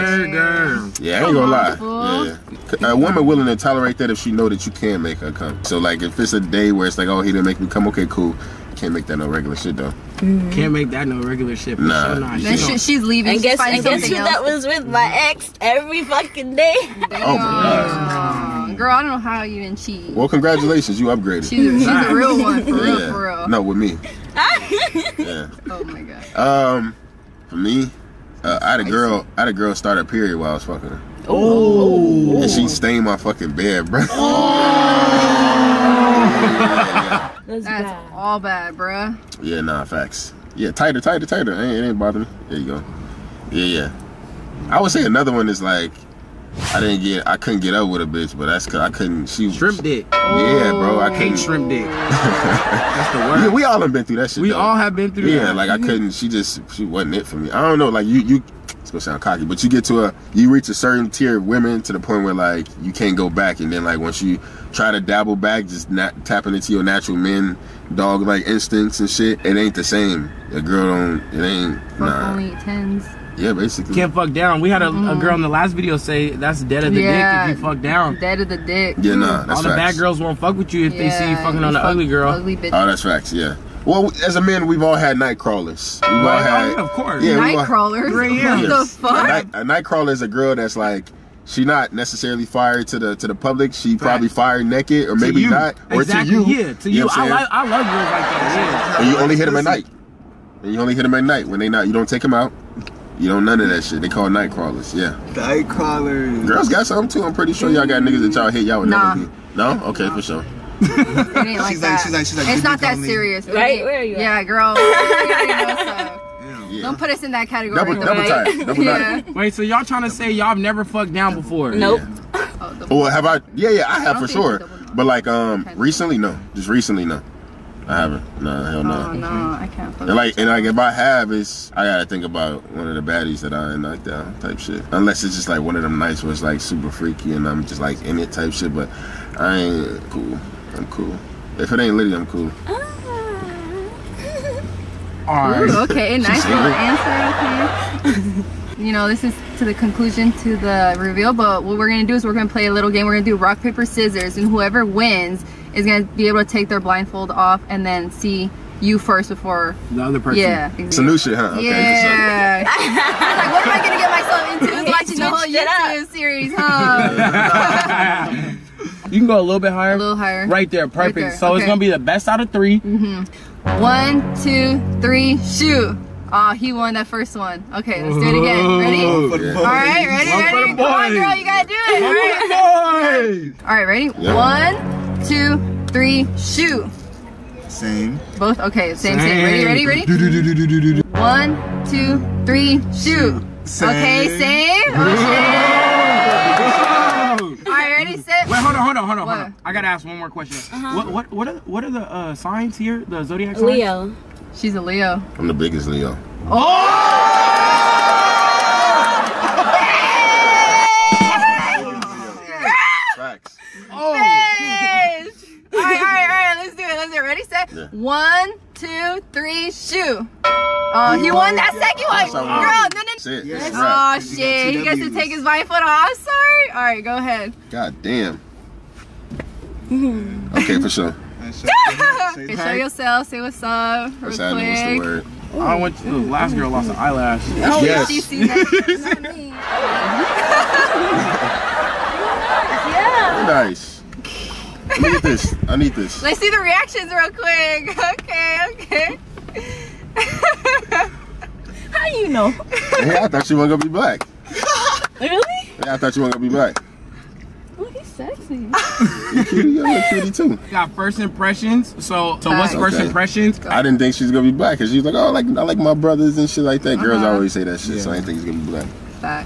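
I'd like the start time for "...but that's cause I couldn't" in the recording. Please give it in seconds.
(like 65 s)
48 s.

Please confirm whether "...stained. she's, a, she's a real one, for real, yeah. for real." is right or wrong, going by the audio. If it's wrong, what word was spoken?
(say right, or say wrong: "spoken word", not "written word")
wrong: "upgraded", not "stained".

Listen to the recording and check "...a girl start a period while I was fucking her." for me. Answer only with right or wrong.
right.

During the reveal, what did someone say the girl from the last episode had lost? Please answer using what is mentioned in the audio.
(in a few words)
An eyelash.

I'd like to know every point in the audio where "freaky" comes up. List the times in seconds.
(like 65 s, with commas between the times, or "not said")
136 s.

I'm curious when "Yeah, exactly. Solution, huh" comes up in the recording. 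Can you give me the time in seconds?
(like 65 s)
160 s.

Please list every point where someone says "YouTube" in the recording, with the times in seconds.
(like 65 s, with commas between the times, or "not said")
165 s.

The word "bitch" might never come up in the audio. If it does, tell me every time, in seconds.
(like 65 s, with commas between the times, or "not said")
48 s, 82 s, 214 s.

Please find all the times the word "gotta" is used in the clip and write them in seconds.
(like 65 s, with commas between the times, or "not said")
131 s, 181 s, 199 s.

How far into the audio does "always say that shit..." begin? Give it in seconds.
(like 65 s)
267 s.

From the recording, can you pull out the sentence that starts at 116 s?
Don't put us in that category.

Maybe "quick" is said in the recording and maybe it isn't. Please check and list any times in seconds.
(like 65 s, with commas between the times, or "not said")
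234 s, 247 s.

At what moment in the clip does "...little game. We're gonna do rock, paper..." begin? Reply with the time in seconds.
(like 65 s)
152 s.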